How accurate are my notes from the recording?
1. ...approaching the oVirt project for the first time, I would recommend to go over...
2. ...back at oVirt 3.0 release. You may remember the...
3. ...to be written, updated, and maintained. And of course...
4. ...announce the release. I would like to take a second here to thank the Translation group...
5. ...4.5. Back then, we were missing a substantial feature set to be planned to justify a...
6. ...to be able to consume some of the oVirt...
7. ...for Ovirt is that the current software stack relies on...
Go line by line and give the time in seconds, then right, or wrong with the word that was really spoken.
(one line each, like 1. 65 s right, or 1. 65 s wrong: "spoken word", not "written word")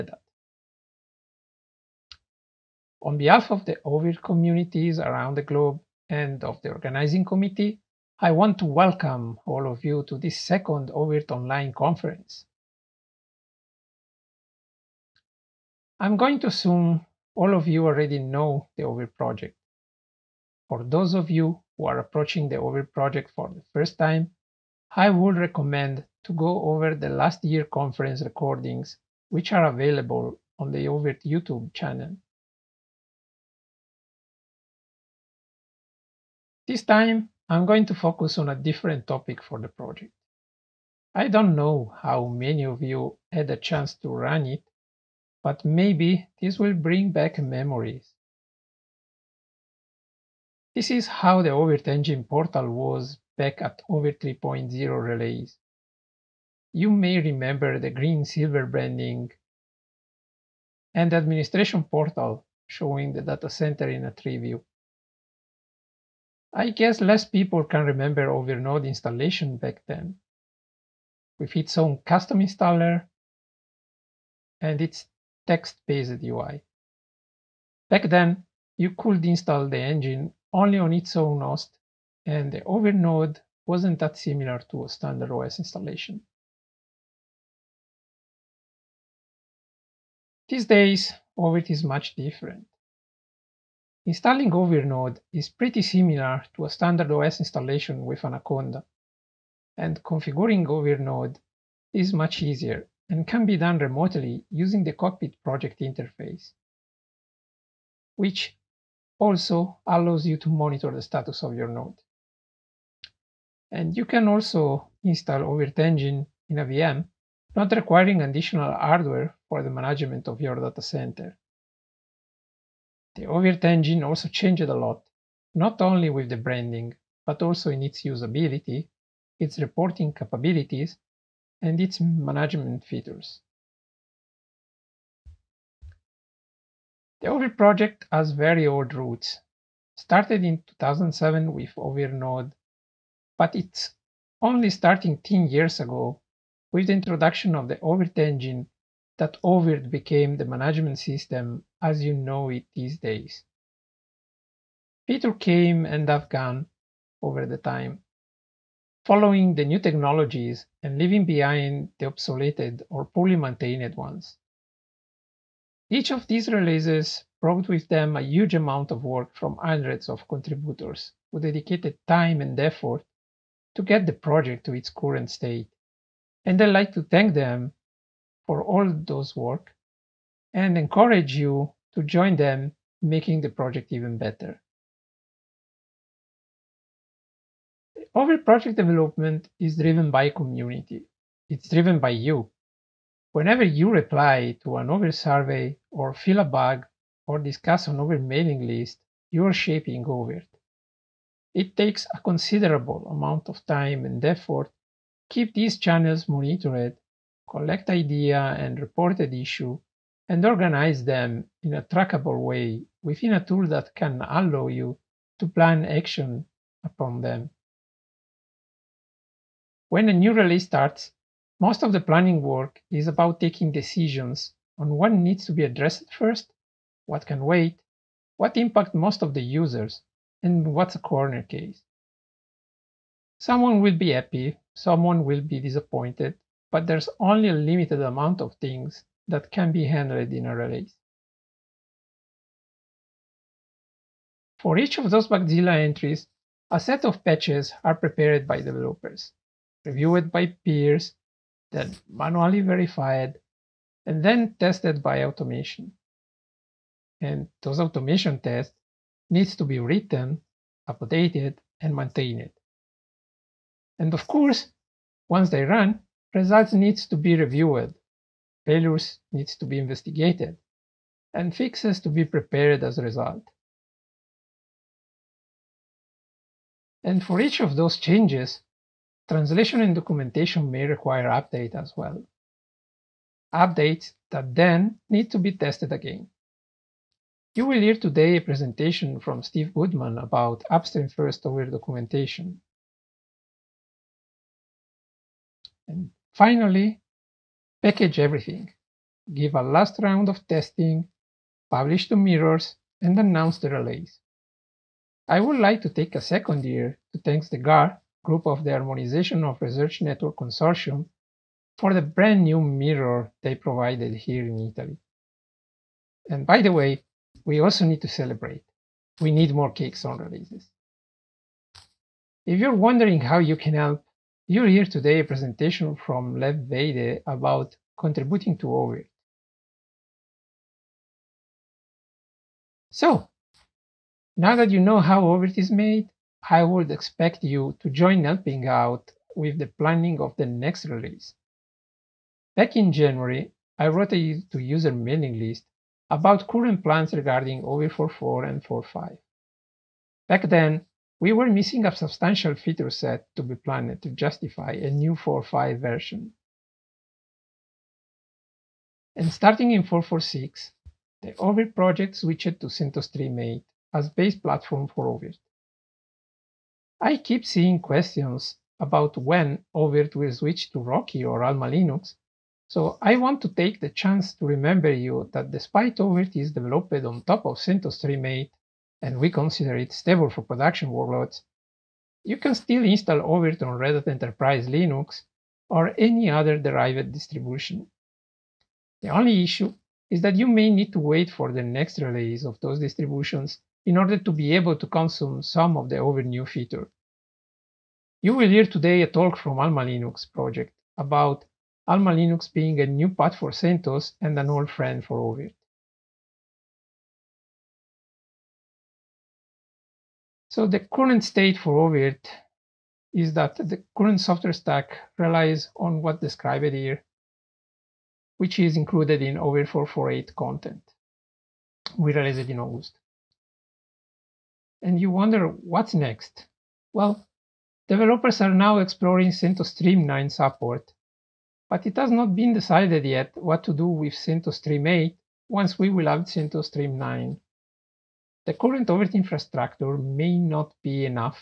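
1. 21 s right
2. 53 s right
3. 259 s right
4. 303 s wrong: "GAR", not "Translation"
5. 348 s right
6. 394 s right
7. 411 s right.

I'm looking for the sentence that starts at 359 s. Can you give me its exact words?
And starting in 4.4.6, the oVirt project switched to CentOS 3.8 as base platform for oVirt.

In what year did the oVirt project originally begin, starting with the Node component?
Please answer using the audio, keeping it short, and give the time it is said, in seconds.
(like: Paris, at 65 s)
2007, at 140 s.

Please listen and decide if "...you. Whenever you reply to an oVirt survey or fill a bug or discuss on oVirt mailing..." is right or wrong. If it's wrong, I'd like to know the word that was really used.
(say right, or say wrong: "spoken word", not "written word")
right.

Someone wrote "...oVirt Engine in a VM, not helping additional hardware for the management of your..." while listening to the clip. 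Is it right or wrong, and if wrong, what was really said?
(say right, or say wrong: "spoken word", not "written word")
wrong: "requiring", not "helping".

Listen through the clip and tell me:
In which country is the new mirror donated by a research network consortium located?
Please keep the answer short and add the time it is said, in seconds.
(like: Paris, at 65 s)
Italy, at 314 s.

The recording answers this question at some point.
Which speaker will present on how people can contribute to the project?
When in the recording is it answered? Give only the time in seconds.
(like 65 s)
326 s.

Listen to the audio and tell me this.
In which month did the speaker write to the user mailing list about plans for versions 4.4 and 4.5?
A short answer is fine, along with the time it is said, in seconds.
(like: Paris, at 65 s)
January, at 342 s.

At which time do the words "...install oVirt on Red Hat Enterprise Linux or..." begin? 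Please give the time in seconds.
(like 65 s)
382 s.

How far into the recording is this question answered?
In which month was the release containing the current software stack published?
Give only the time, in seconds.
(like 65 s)
422 s.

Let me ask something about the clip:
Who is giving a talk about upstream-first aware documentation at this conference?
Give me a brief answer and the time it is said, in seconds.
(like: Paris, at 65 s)
Steve Goodman, at 289 s.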